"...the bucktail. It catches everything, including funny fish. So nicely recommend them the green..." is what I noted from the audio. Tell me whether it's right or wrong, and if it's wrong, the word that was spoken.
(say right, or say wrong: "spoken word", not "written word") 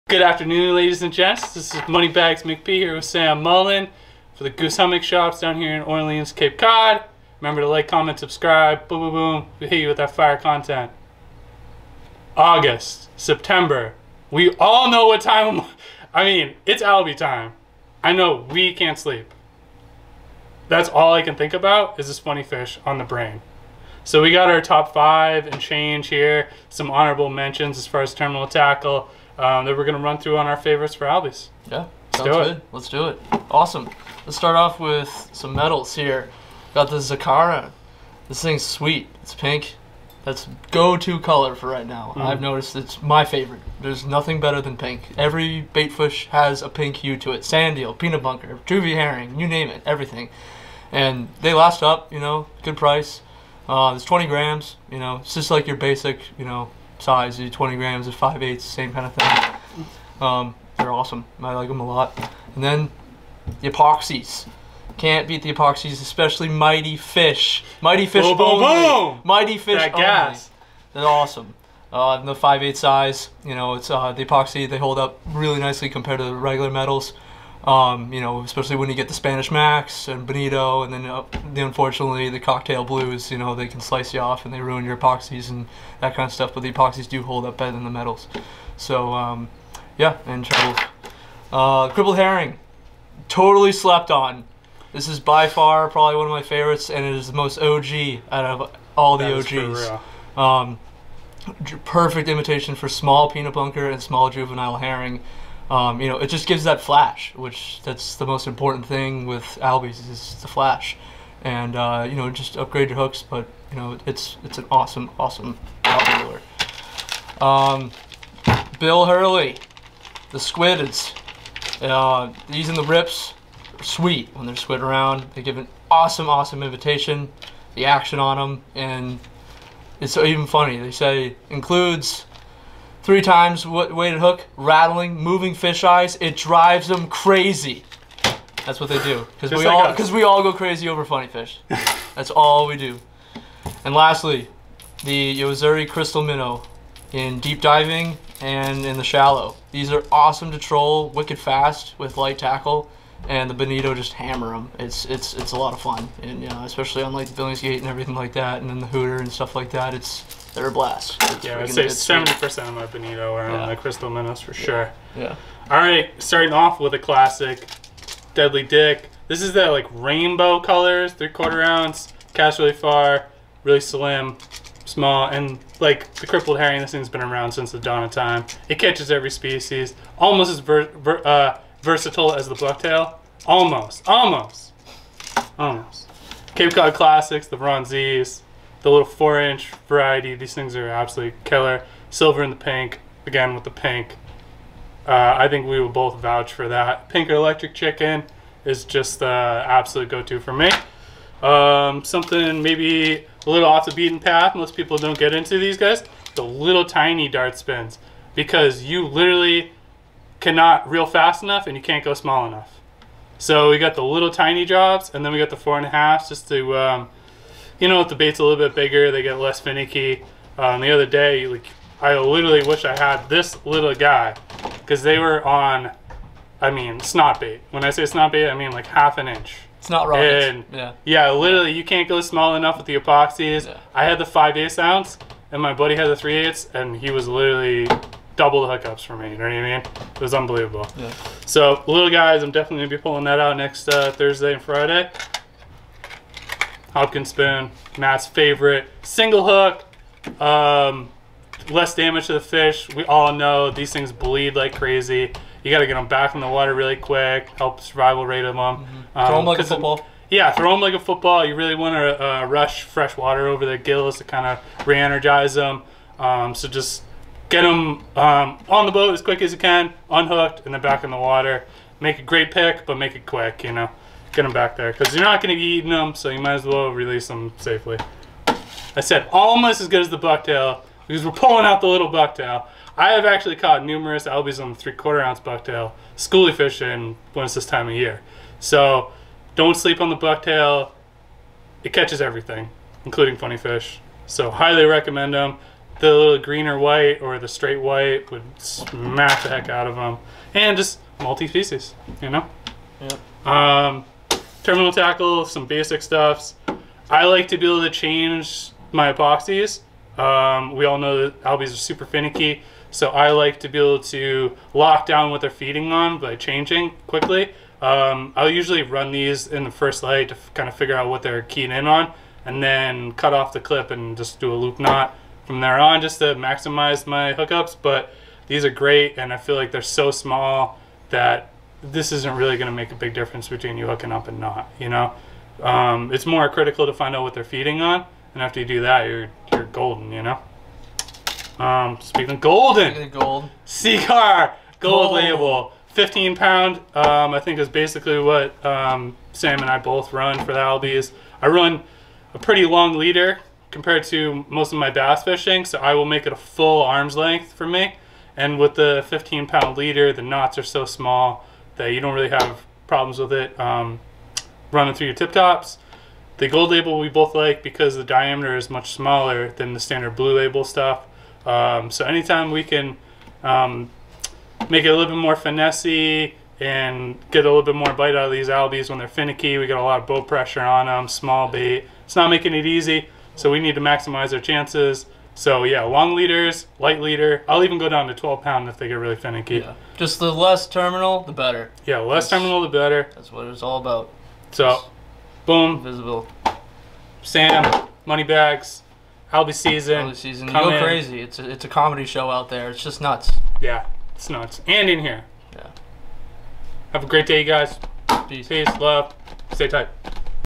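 wrong: "highly", not "nicely".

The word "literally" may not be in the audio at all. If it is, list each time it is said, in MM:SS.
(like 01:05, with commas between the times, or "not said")
03:29, 03:42, 03:51, 03:57.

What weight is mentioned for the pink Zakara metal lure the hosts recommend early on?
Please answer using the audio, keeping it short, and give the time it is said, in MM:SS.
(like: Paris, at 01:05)
20 grams, at 00:53.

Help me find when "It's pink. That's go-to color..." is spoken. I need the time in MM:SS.
00:39.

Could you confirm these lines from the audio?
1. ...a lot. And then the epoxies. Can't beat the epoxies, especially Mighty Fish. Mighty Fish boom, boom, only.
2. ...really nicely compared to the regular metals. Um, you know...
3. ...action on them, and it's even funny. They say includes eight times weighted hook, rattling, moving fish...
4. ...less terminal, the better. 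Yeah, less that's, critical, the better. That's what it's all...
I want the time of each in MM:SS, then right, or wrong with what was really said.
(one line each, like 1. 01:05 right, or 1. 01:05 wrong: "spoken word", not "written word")
1. 01:01 right
2. 01:15 right
3. 02:07 wrong: "three", not "eight"
4. 06:30 wrong: "terminal", not "critical".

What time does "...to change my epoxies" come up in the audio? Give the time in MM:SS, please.
05:07.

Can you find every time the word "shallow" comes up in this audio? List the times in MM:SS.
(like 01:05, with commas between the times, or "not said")
02:29.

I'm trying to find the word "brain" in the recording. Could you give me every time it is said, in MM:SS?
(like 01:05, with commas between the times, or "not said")
00:23.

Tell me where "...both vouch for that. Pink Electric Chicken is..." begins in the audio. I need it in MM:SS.
03:15.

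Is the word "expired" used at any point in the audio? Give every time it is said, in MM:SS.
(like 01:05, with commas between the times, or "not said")
not said.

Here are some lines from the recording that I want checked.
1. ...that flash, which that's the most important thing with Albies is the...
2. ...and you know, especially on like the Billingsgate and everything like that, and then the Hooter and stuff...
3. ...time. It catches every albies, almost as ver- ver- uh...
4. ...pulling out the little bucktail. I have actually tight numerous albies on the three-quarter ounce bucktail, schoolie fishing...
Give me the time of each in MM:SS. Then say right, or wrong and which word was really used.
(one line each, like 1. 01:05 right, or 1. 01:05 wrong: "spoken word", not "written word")
1. 01:46 right
2. 02:36 right
3. 02:58 wrong: "species", not "albies"
4. 04:41 wrong: "caught", not "tight".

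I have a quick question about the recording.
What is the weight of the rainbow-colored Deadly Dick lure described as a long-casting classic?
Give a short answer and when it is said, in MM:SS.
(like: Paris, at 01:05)
3/4 ounce, at 02:51.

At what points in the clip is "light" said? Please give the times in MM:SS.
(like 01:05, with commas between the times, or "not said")
02:32, 05:20, 06:26.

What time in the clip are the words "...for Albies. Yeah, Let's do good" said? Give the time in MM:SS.
00:30.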